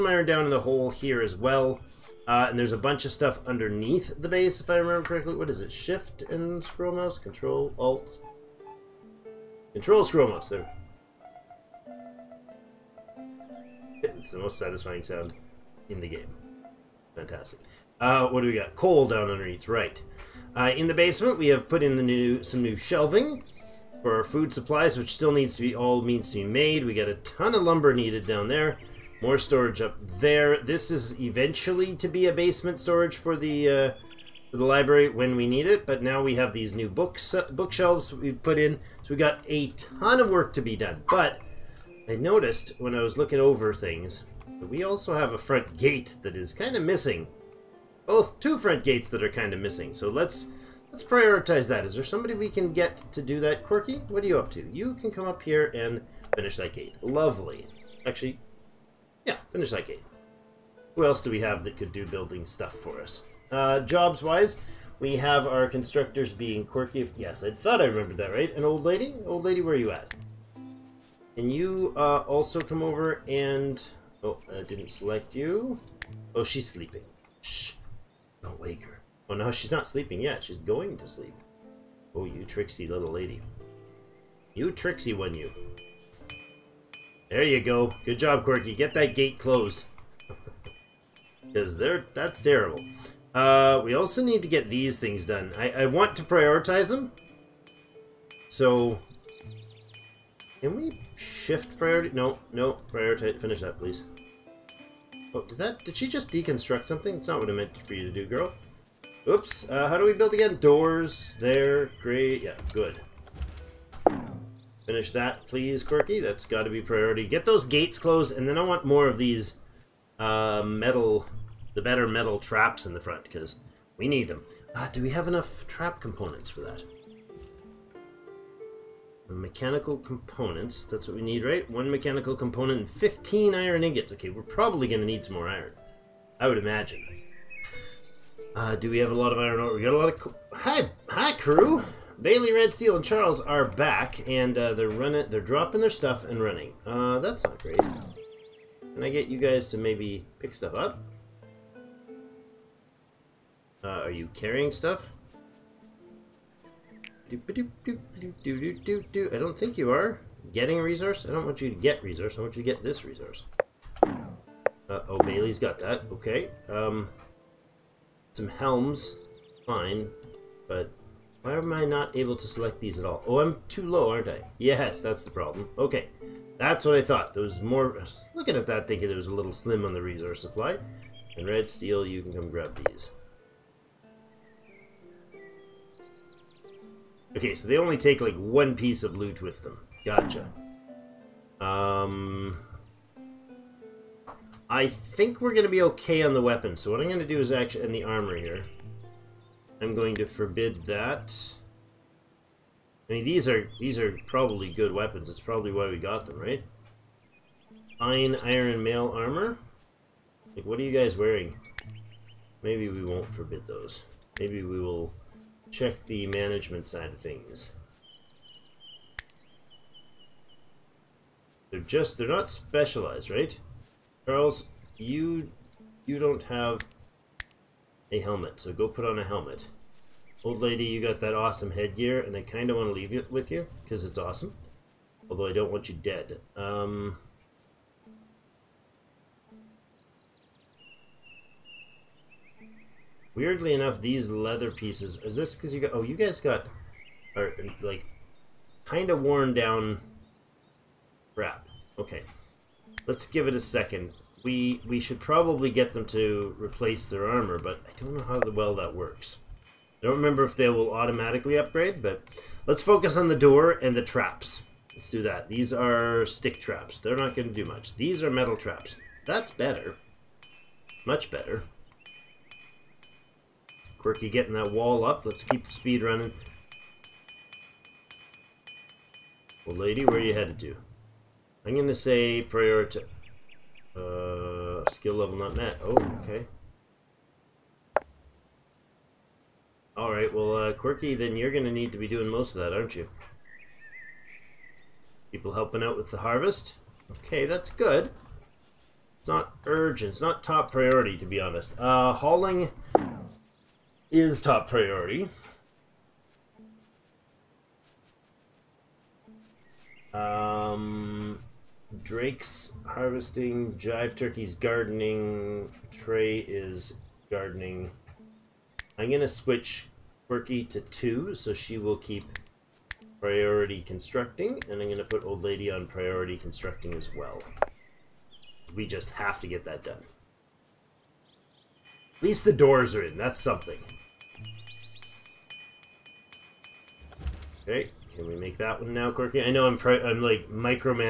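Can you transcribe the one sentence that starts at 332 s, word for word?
At least the doors are in, that's something.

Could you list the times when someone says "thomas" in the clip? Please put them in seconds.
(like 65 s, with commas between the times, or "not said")
not said.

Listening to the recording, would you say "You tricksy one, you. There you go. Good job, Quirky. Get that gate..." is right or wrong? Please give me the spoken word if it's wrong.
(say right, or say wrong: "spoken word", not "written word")
right.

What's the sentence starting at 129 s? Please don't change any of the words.
Mechanical components, that's what we need, right?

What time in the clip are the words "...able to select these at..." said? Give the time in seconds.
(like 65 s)
172 s.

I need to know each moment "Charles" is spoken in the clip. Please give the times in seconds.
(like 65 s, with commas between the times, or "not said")
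143 s, 224 s.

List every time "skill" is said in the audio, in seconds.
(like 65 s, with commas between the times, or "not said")
284 s.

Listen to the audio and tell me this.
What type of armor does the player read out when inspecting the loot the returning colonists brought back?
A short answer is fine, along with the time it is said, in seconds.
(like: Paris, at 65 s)
Fine iron mail armor, at 207 s.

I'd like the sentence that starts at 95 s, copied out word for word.
I, I want to prioritize them.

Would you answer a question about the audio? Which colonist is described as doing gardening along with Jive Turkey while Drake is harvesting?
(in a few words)
Trey.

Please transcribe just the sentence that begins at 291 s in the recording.
Then you're gonna need to be doing most of that, aren't you?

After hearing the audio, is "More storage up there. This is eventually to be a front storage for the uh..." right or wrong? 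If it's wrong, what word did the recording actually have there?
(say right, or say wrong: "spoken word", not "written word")
wrong: "basement", not "front".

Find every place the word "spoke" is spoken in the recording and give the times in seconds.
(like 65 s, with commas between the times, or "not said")
not said.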